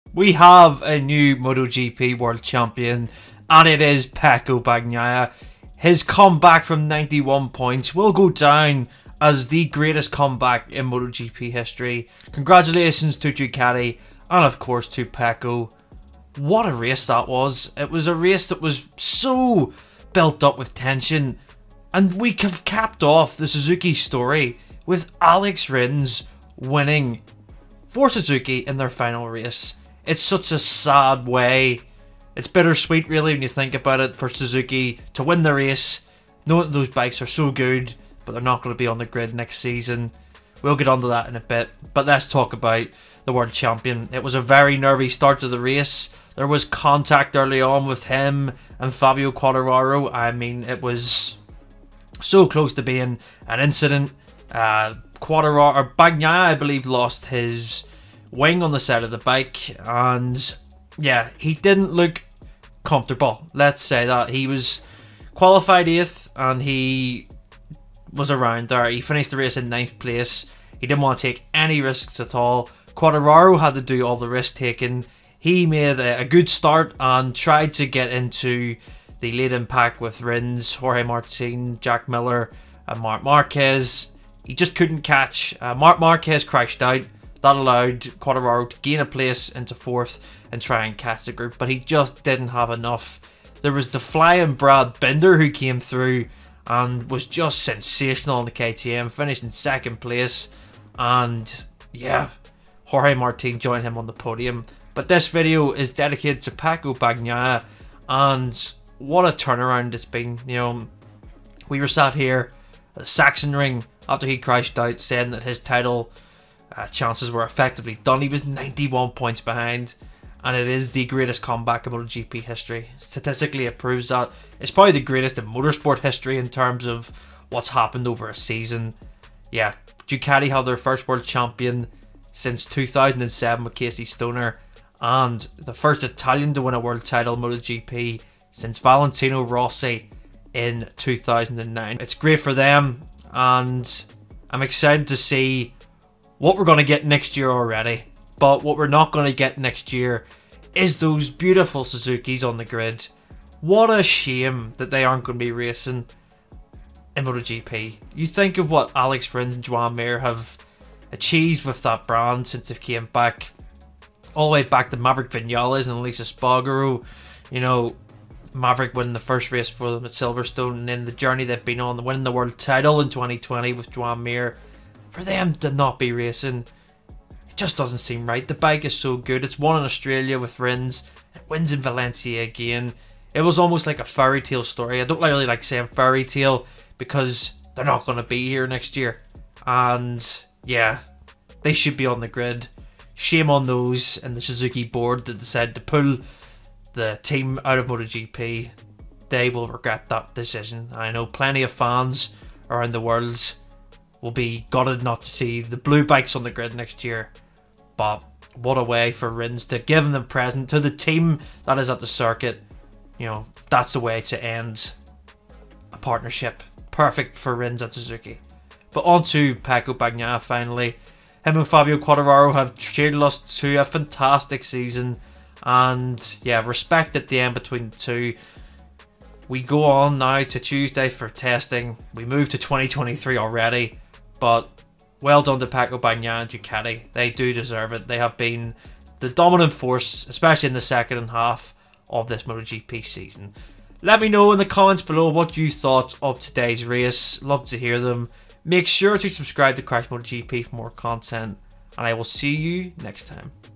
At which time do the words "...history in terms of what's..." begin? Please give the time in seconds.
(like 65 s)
125 s.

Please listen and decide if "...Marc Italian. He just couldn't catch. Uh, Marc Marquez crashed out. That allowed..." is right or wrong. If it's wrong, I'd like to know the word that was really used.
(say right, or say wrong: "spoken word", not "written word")
wrong: "Marquez", not "Italian".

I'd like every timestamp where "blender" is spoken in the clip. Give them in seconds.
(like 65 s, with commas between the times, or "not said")
not said.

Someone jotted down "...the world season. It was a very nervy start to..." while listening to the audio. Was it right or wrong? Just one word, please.
wrong.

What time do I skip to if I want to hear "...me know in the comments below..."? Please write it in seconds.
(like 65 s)
244 s.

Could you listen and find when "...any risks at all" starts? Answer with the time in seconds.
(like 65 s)
71 s.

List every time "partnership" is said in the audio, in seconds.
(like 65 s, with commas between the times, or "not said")
215 s.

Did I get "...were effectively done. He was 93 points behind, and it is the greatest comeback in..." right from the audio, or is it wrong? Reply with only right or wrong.
wrong.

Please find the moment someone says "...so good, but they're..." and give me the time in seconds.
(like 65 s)
37 s.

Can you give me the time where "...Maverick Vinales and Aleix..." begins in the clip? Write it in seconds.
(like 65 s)
164 s.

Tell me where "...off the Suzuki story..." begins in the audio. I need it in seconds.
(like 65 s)
23 s.